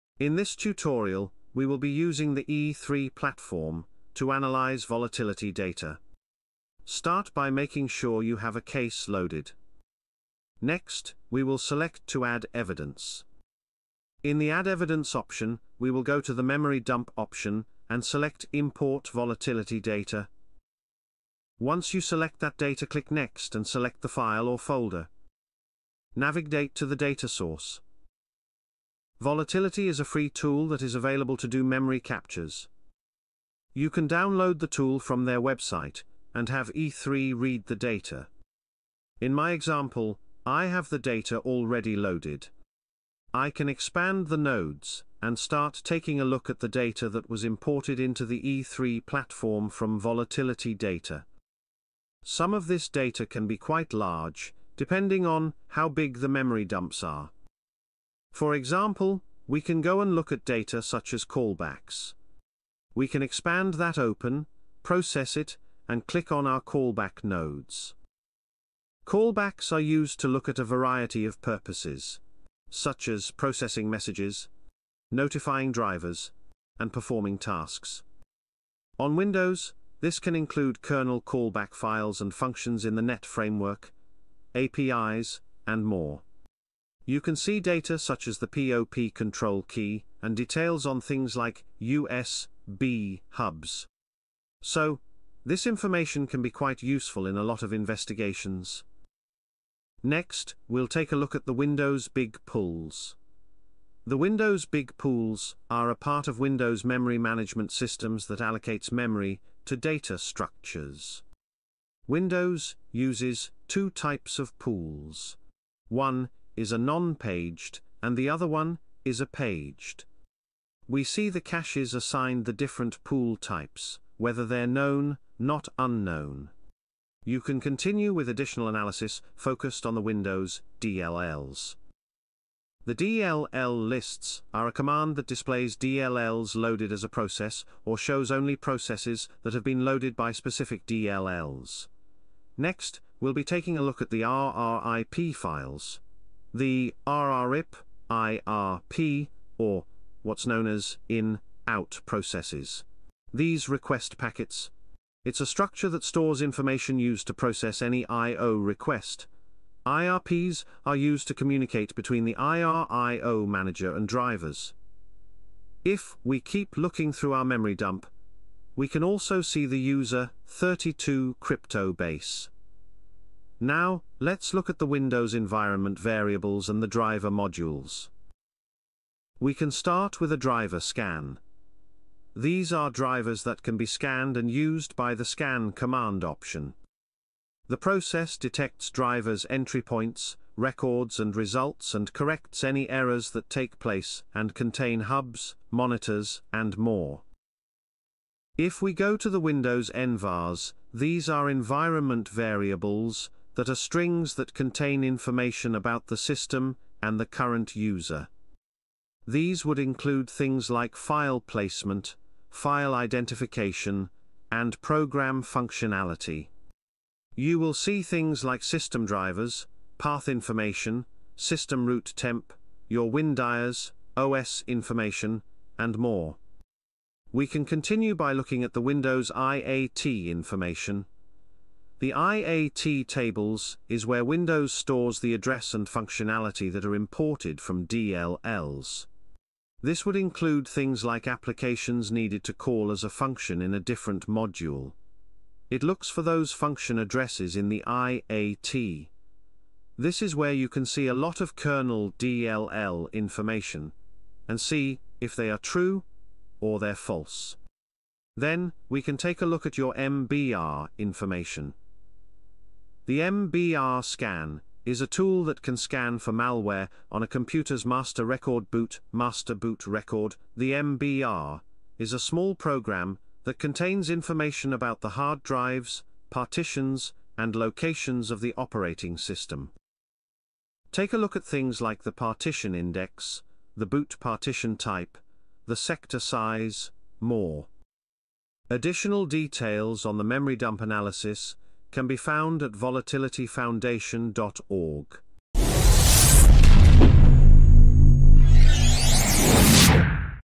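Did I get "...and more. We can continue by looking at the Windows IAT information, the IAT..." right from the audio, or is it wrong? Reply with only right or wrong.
right.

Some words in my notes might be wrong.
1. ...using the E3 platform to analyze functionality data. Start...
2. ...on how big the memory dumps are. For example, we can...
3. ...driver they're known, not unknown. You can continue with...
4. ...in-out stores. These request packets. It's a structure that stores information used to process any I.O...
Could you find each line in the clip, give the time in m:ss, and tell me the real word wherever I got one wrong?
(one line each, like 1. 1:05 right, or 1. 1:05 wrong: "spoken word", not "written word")
1. 0:01 wrong: "volatility", not "functionality"
2. 0:55 right
3. 2:04 wrong: "whether", not "driver"
4. 2:31 wrong: "processes", not "stores".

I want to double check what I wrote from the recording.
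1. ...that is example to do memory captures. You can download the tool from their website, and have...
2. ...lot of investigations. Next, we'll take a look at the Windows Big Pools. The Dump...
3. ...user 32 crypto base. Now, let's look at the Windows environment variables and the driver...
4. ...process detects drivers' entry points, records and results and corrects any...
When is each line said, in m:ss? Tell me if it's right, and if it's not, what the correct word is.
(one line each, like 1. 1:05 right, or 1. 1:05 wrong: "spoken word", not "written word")
1. 0:30 wrong: "available", not "example"
2. 1:37 wrong: "Windows", not "Dump"
3. 2:49 right
4. 3:07 right.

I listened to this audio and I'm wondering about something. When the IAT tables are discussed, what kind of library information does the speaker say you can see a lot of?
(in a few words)
kernel DLL.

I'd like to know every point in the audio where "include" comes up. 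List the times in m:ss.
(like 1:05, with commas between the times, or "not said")
1:20, 3:29, 4:00.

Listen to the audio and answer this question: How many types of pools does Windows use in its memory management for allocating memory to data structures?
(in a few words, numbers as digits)
2.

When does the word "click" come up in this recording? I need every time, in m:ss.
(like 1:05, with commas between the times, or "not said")
0:22, 1:06.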